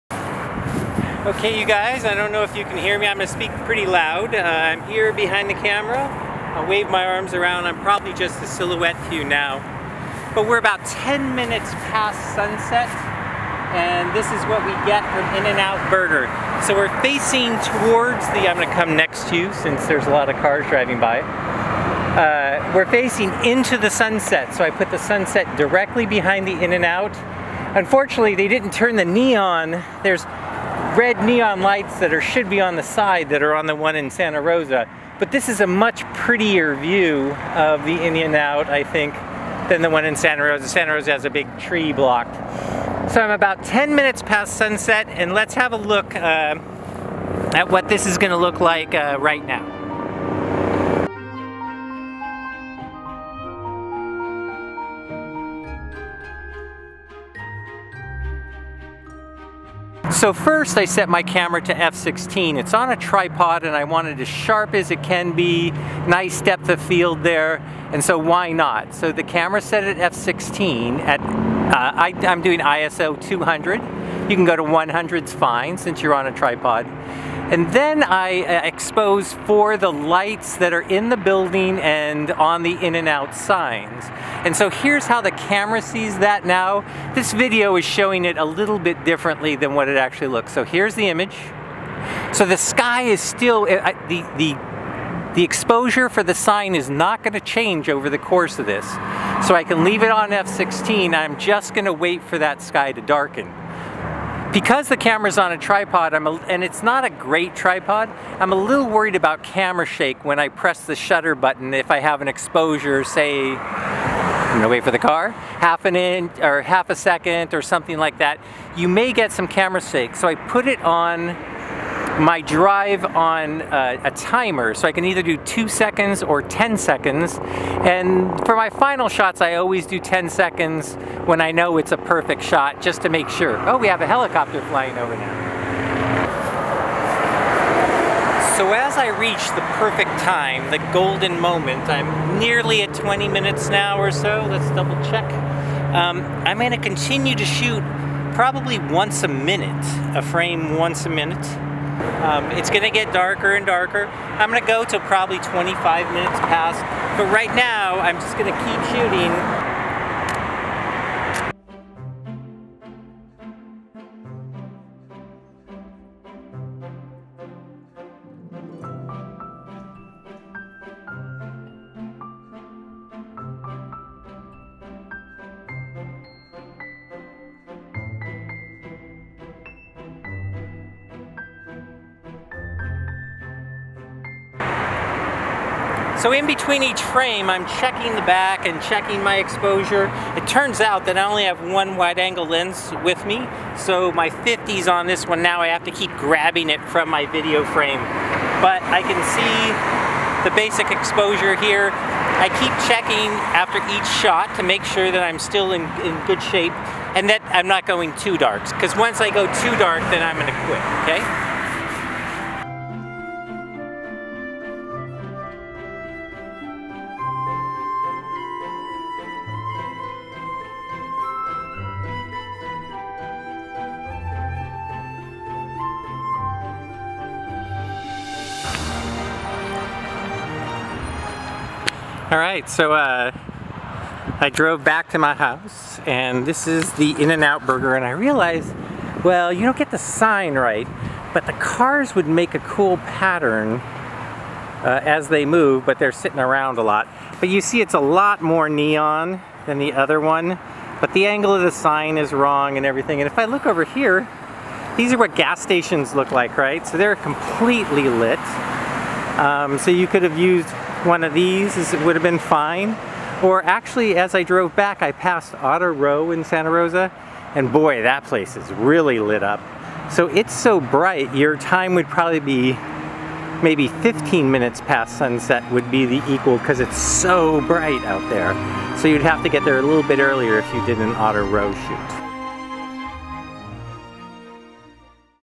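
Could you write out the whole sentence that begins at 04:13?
And if I look over here, these are what gas stations look like, right?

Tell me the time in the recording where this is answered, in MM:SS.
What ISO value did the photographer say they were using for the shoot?
01:12.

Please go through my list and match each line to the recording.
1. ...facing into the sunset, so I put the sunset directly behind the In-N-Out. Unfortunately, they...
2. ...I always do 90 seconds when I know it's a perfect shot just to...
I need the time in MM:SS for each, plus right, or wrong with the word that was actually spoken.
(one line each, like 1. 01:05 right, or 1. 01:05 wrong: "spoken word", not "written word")
1. 00:22 right
2. 02:09 wrong: "10", not "90".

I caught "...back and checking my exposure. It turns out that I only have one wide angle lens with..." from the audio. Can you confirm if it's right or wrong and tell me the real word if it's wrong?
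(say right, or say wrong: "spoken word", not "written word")
right.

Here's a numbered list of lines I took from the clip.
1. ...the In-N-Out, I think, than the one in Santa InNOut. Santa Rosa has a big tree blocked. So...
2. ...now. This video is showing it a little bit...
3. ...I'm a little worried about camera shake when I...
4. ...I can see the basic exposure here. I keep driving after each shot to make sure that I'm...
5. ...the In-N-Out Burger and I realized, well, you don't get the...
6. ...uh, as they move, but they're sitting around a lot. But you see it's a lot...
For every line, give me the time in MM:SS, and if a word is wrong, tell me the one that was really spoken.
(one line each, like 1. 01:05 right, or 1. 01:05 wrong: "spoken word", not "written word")
1. 00:37 wrong: "Rosa", not "InNOut"
2. 01:26 right
3. 01:48 right
4. 03:18 wrong: "checking", not "driving"
5. 03:56 right
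6. 04:04 right.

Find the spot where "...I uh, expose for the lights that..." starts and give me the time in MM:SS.
01:18.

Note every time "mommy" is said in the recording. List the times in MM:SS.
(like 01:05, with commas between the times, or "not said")
not said.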